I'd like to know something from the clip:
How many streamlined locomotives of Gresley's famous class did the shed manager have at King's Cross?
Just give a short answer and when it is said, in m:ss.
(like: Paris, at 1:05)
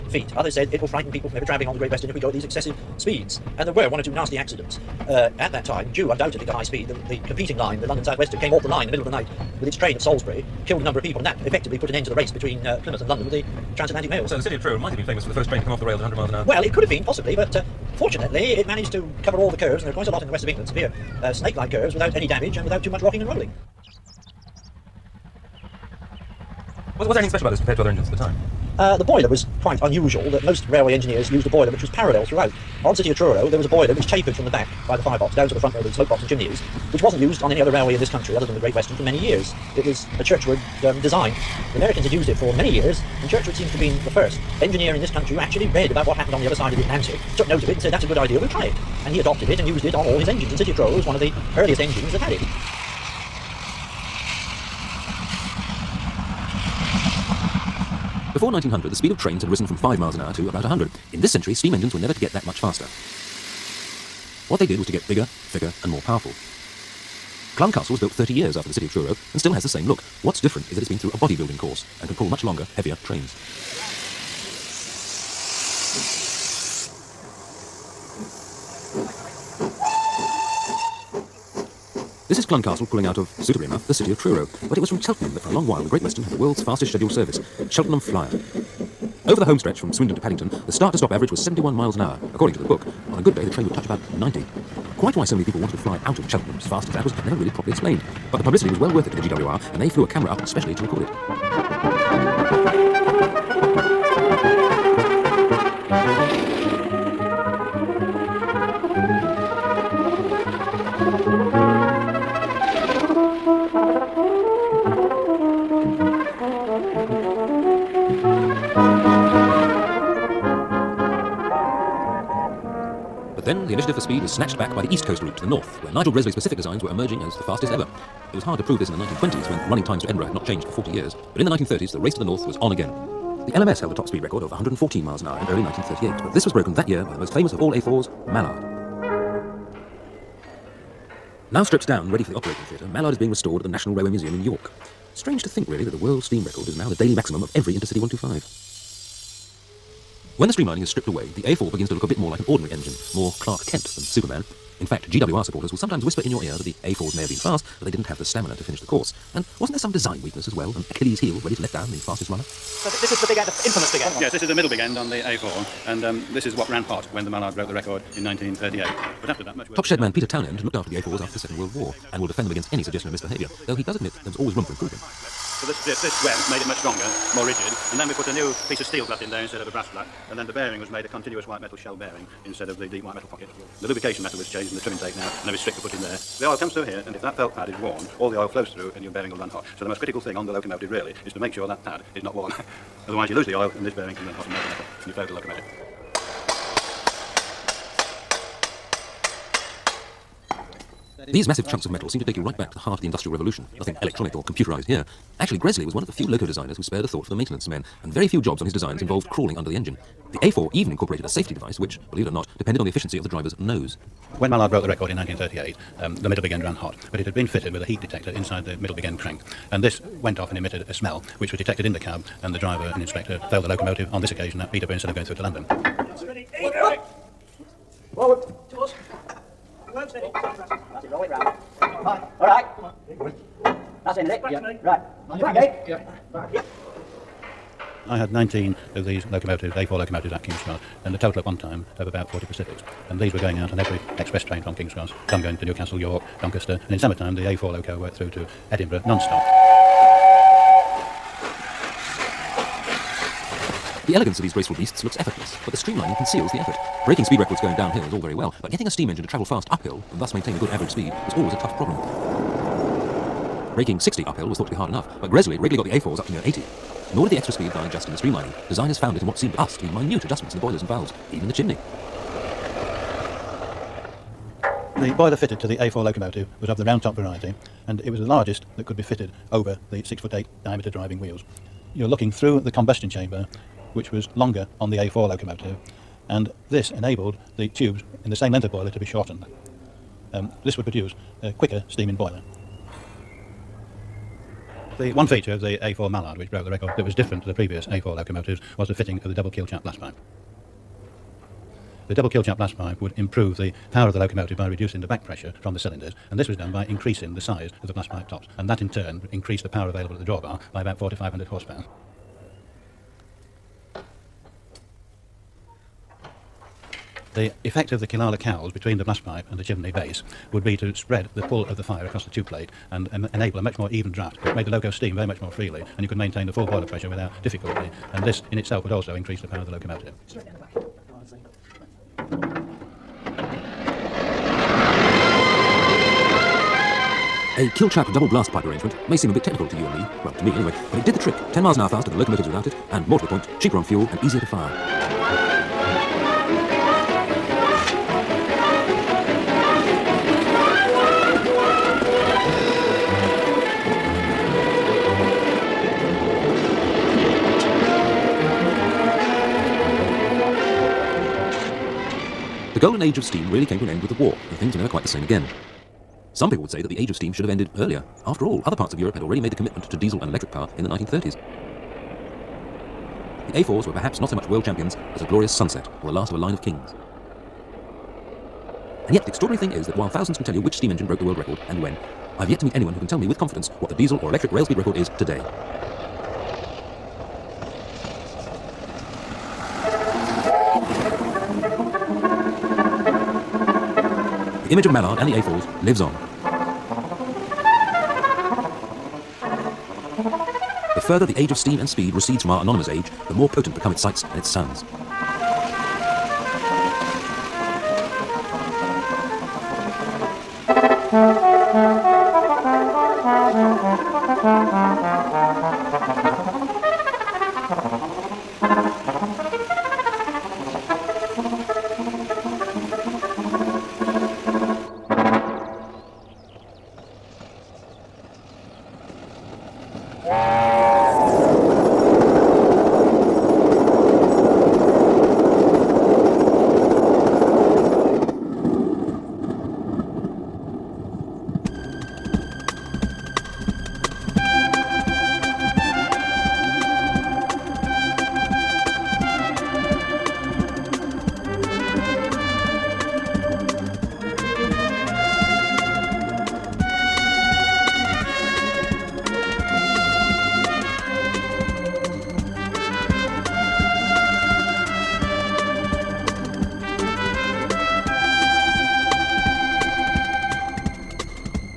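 19, at 3:58.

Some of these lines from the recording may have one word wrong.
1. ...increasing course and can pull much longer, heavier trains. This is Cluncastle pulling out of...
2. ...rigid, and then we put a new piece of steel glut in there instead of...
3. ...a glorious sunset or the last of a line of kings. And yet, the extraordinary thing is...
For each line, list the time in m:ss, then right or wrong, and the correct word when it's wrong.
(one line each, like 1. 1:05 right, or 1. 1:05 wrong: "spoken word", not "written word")
1. 1:11 wrong: "bodybuilding", not "increasing"
2. 2:57 right
3. 6:15 right.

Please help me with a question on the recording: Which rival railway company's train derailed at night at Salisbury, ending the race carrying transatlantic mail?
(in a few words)
London South Western.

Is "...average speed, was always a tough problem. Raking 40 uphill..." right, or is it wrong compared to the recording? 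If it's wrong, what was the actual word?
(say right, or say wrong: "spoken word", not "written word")
wrong: "60", not "40".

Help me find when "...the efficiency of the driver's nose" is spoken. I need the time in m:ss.
3:32.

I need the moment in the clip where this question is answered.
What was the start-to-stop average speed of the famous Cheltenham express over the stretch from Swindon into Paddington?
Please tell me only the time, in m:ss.
1:31.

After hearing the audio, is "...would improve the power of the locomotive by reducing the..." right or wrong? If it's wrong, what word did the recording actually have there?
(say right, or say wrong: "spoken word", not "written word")
right.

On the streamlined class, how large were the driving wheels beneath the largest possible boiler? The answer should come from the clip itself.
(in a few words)
6 foot 8.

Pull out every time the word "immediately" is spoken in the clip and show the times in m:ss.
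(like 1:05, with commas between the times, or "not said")
not said.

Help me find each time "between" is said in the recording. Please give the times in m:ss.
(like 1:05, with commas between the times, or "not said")
0:12, 5:18.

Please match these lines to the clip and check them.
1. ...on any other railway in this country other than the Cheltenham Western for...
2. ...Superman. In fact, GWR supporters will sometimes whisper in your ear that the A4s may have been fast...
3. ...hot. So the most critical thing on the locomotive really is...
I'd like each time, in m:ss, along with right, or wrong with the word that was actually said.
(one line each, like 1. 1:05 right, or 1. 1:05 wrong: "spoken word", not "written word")
1. 0:37 wrong: "Great", not "Cheltenham"
2. 2:34 right
3. 3:09 right.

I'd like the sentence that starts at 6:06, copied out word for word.
Some people would say that the age of steam should have ended earlier.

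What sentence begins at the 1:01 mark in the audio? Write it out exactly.
In this century, steam engines were never to get that much faster.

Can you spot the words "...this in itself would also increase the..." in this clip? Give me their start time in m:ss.
5:28.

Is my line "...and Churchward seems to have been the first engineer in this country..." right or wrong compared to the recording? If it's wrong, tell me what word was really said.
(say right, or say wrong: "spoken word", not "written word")
right.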